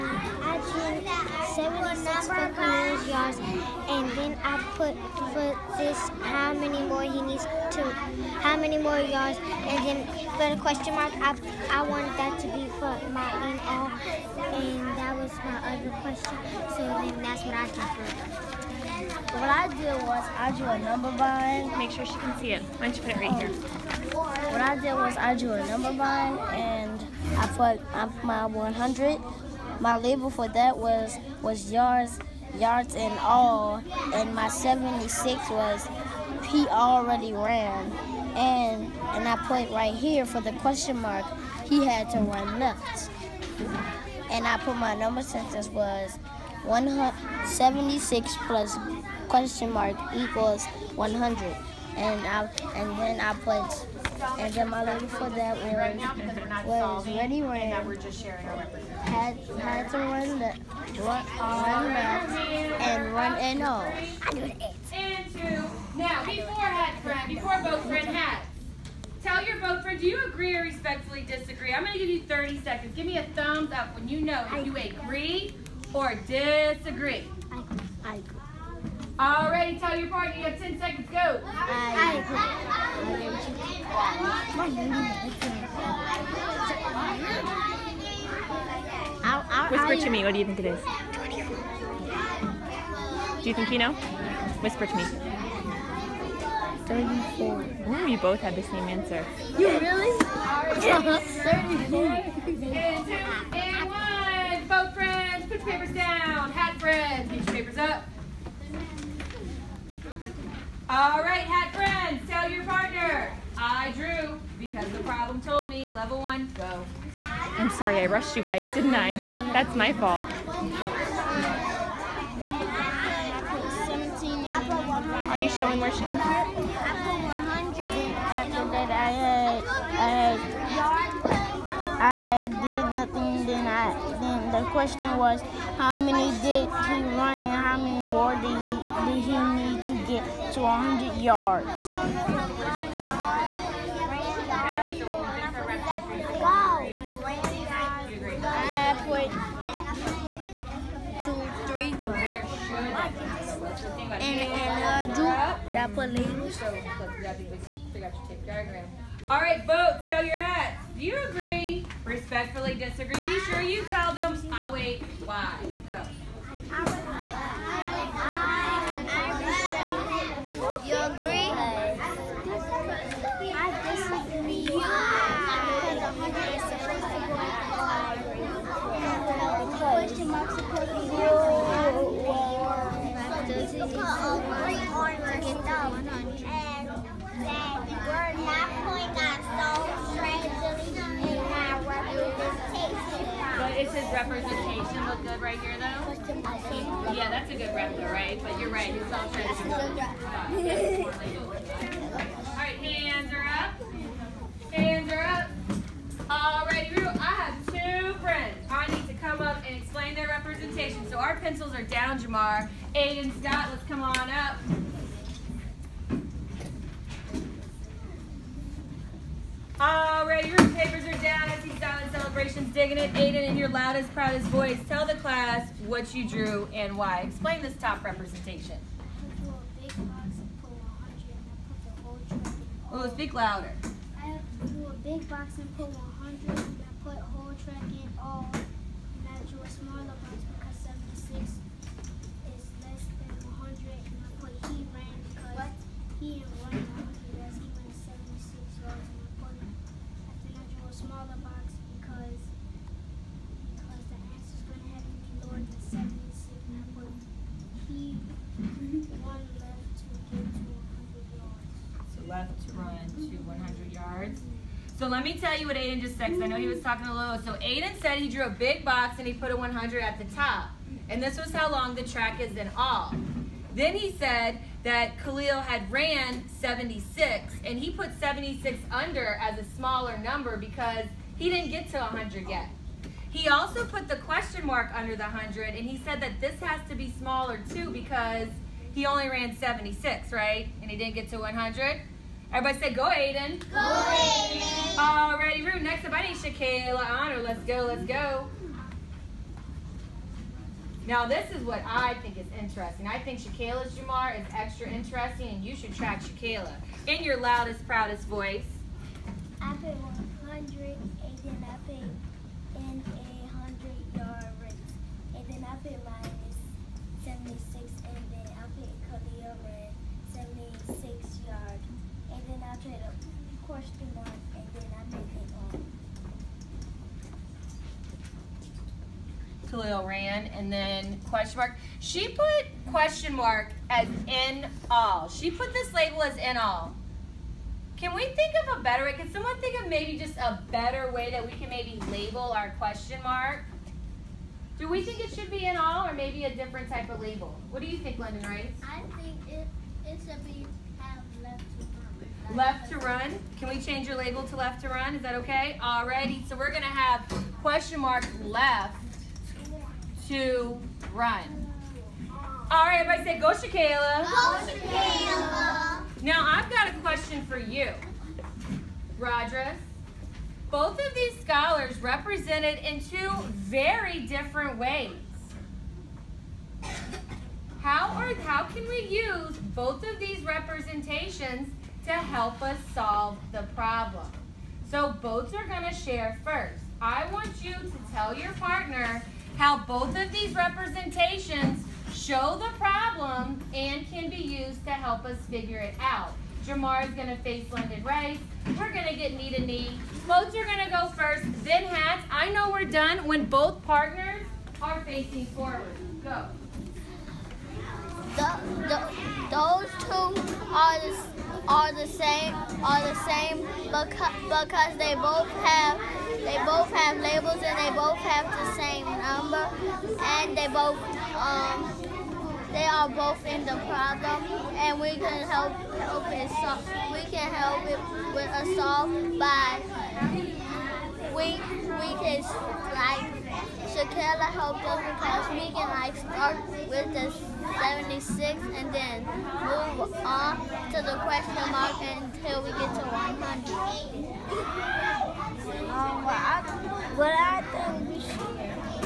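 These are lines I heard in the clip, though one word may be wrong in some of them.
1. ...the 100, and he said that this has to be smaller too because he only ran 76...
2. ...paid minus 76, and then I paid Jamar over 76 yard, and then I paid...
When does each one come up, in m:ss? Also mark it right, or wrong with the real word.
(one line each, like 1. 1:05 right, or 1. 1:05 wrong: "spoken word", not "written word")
1. 4:45 right
2. 5:15 wrong: "Cody", not "Jamar".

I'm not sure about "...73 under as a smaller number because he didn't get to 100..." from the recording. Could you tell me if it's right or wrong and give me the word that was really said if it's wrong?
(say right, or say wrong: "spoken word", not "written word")
wrong: "76", not "73".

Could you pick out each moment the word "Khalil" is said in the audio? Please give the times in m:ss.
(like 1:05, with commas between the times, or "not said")
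4:35, 5:29.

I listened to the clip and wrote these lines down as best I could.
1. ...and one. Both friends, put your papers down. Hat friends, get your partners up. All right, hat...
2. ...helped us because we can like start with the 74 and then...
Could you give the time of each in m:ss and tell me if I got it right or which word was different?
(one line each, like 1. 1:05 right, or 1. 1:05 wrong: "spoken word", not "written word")
1. 1:43 wrong: "papers", not "partners"
2. 7:14 wrong: "76", not "74".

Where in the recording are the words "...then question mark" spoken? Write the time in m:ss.
5:30.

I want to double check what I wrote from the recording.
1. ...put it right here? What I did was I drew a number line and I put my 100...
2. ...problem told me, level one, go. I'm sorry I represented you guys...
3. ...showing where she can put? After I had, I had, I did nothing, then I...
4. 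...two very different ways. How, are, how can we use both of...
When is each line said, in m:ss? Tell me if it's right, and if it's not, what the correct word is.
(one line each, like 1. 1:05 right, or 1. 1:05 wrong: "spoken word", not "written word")
1. 0:23 right
2. 1:54 wrong: "rushed", not "represented"
3. 2:05 right
4. 6:13 right.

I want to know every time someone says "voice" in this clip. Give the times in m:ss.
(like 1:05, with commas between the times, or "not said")
3:44, 5:08.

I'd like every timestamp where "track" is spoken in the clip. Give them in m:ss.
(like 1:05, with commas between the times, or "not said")
3:57, 4:32, 5:05.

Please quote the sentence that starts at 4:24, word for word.
So let me tell you what Aiden just said, because I know he was talking a little.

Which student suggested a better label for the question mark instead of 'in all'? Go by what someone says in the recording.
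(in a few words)
London Rice.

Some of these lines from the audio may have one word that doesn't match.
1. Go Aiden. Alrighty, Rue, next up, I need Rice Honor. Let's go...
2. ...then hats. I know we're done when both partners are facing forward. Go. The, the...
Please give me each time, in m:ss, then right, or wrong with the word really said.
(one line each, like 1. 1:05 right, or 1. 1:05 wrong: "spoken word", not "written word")
1. 4:53 wrong: "Shaquille", not "Rice"
2. 6:41 right.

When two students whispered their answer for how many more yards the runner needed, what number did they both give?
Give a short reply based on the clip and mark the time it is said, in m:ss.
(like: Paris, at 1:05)
34, at 1:36.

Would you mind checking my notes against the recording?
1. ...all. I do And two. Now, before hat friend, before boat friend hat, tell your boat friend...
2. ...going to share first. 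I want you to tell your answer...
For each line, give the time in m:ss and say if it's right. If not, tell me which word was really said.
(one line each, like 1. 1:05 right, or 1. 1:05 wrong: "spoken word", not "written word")
1. 1:03 right
2. 6:25 wrong: "partner", not "answer".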